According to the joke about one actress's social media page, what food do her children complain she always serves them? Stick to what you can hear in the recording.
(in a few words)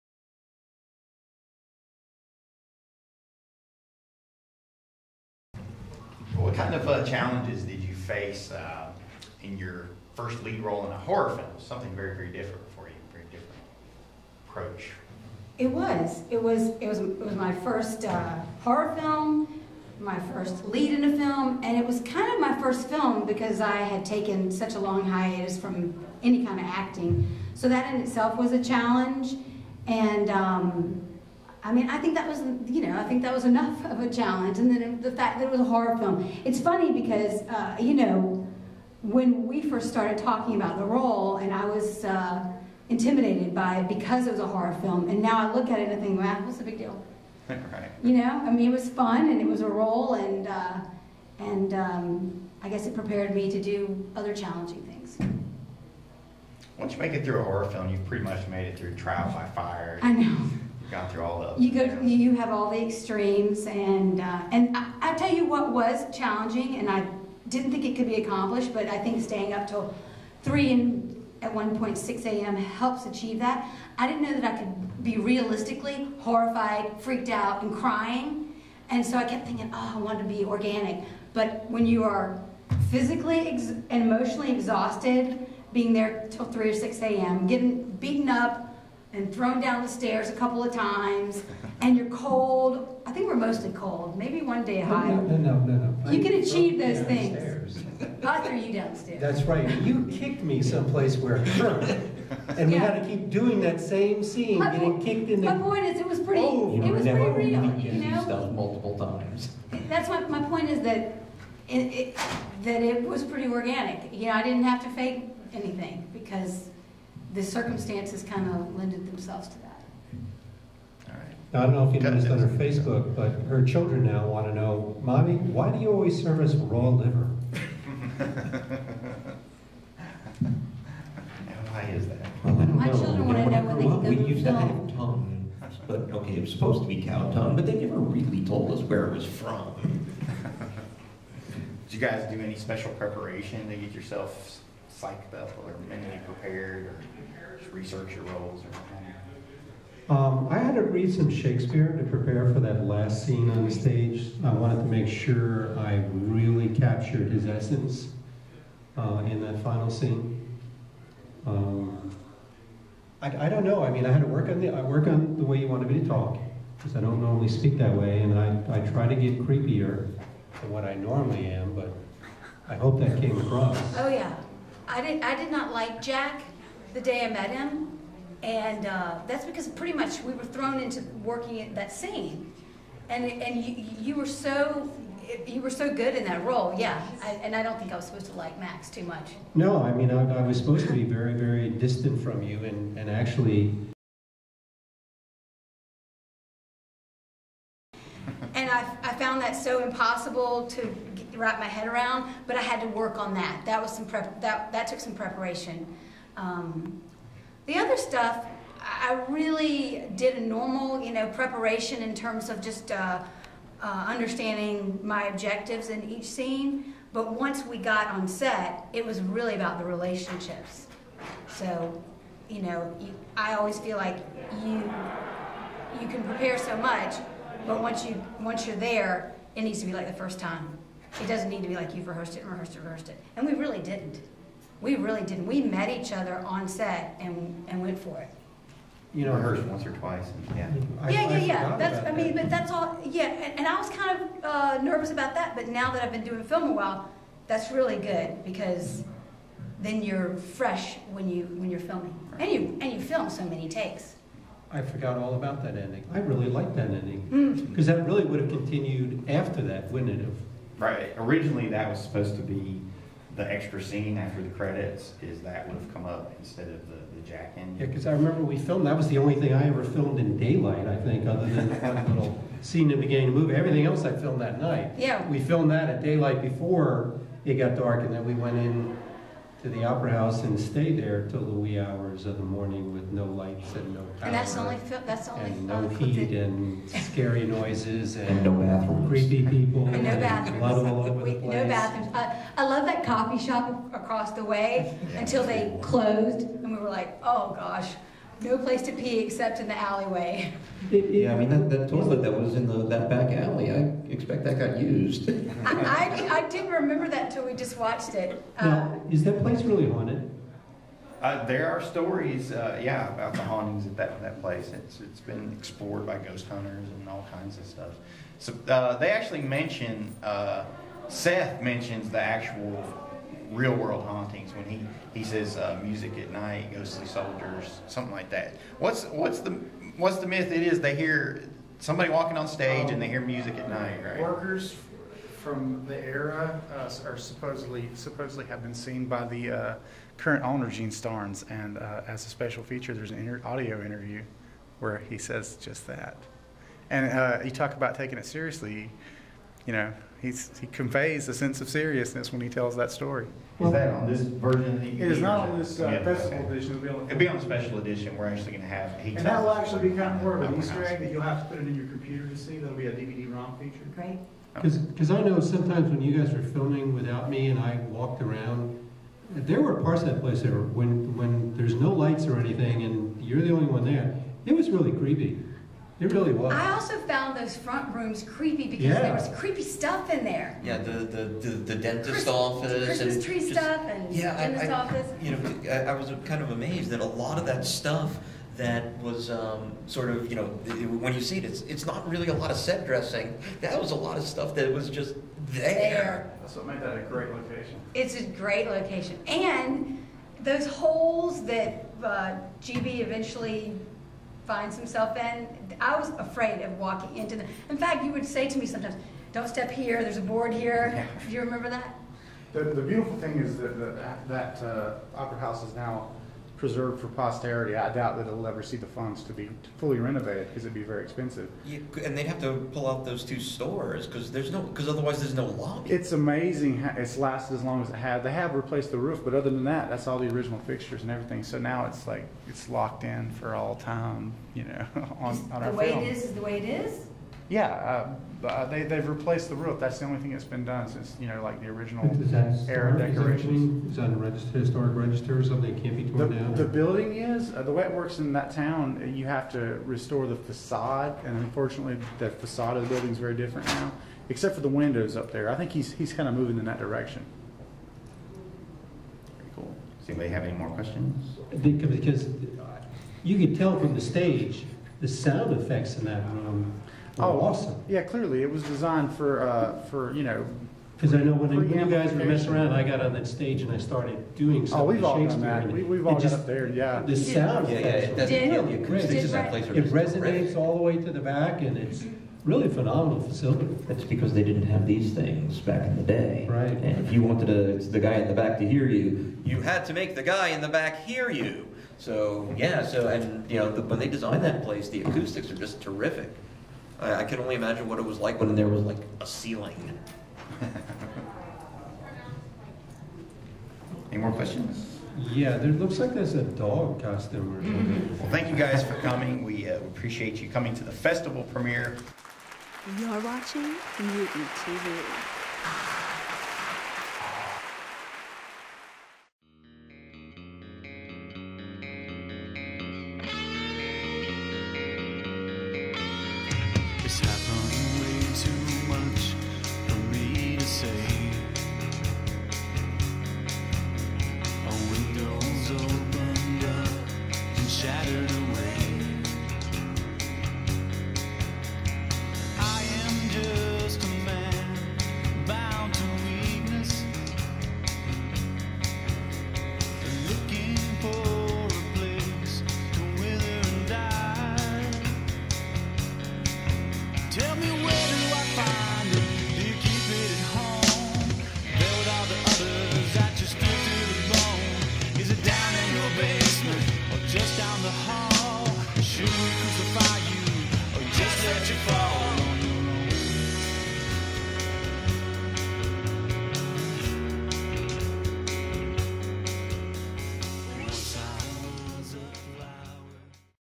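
raw liver.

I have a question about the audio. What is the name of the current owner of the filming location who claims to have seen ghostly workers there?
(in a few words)
Gene Starnes.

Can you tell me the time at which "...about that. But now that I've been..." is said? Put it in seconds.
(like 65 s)
245 s.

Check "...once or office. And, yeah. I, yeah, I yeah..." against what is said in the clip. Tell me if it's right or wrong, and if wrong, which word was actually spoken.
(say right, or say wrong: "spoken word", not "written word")
wrong: "twice", not "office".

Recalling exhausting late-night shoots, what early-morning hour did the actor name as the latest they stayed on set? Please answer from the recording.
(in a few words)
6 a.m.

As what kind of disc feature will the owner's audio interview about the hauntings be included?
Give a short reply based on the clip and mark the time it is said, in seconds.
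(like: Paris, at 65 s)
DVD-ROM feature, at 362 s.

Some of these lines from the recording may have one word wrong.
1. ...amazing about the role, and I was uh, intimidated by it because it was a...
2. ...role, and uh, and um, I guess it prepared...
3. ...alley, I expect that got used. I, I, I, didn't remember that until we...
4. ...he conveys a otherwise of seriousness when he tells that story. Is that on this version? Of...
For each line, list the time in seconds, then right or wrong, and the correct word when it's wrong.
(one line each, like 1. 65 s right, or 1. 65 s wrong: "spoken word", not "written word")
1. 40 s wrong: "talking", not "amazing"
2. 49 s right
3. 303 s right
4. 350 s wrong: "sense", not "otherwise".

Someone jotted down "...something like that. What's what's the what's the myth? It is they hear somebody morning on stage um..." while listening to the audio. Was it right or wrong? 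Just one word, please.
wrong.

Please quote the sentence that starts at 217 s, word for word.
But once we got on set, it was really about the relationships.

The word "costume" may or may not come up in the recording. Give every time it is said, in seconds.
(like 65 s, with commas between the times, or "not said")
507 s.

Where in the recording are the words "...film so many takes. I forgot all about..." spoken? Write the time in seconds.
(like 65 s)
253 s.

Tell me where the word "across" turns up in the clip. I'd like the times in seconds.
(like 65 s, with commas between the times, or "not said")
173 s, 293 s.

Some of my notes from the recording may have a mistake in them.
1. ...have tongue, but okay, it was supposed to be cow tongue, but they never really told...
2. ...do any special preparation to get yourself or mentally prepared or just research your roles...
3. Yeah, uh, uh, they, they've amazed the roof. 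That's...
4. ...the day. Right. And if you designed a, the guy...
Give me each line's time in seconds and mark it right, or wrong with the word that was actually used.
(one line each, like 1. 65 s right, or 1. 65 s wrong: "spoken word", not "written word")
1. 134 s right
2. 142 s right
3. 437 s wrong: "replaced", not "amazed"
4. 485 s wrong: "wanted", not "designed".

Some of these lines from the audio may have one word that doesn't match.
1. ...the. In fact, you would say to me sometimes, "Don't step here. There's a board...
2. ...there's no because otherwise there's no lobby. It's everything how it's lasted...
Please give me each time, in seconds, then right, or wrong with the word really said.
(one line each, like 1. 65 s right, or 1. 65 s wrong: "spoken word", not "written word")
1. 407 s right
2. 424 s wrong: "amazing", not "everything".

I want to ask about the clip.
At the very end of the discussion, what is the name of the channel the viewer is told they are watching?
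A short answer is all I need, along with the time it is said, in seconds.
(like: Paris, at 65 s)
Mutant TV, at 513 s.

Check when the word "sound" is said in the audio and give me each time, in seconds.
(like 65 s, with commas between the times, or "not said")
465 s, 477 s.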